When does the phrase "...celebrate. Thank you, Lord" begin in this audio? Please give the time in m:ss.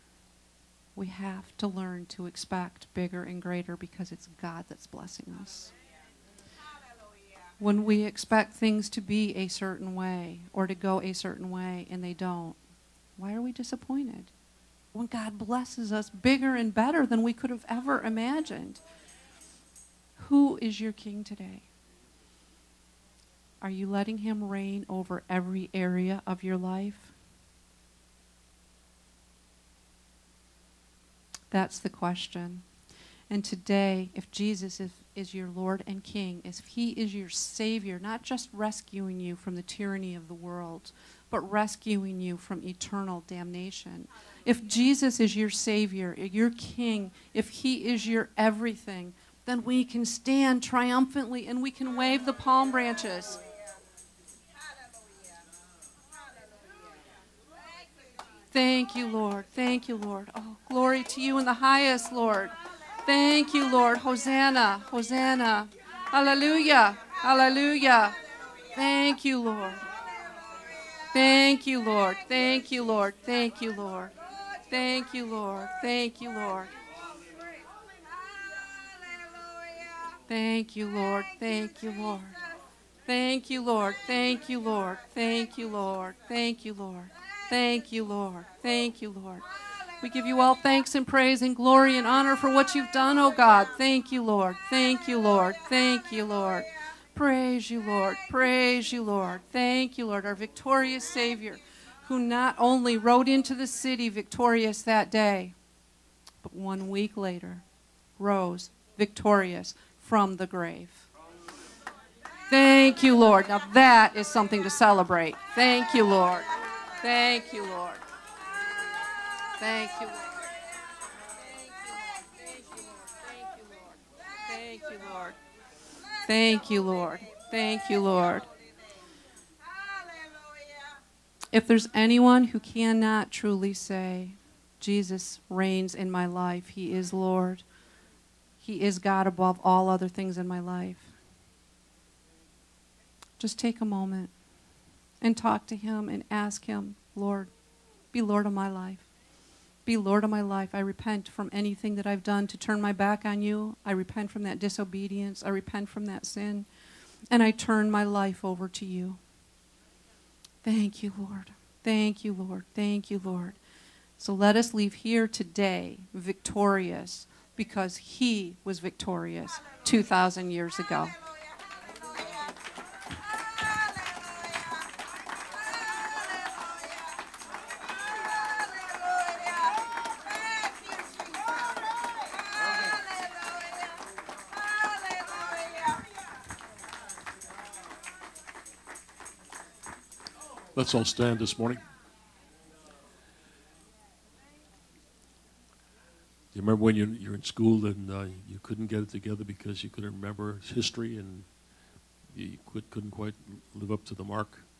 1:54.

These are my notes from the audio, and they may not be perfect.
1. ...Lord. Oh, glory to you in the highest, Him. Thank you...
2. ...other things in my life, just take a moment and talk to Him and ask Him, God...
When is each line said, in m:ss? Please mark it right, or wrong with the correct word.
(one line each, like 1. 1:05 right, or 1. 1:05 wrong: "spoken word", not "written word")
1. 0:59 wrong: "Lord", not "Him"
2. 2:19 wrong: "Lord", not "God".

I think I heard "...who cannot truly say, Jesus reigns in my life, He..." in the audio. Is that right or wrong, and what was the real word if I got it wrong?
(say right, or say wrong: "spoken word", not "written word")
right.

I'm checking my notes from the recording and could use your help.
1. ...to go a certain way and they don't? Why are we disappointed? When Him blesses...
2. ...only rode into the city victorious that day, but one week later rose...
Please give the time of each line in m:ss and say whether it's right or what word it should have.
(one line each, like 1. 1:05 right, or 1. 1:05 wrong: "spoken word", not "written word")
1. 0:10 wrong: "God", not "Him"
2. 1:42 right.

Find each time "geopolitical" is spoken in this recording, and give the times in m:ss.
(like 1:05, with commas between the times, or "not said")
not said.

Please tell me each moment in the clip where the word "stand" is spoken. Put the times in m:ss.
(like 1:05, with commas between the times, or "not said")
0:50, 3:11.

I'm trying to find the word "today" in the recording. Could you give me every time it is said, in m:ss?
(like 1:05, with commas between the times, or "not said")
0:21, 0:33, 2:45.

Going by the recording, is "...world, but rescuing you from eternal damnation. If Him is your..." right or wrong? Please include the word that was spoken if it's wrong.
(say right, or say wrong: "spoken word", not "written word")
wrong: "Jesus", not "Him".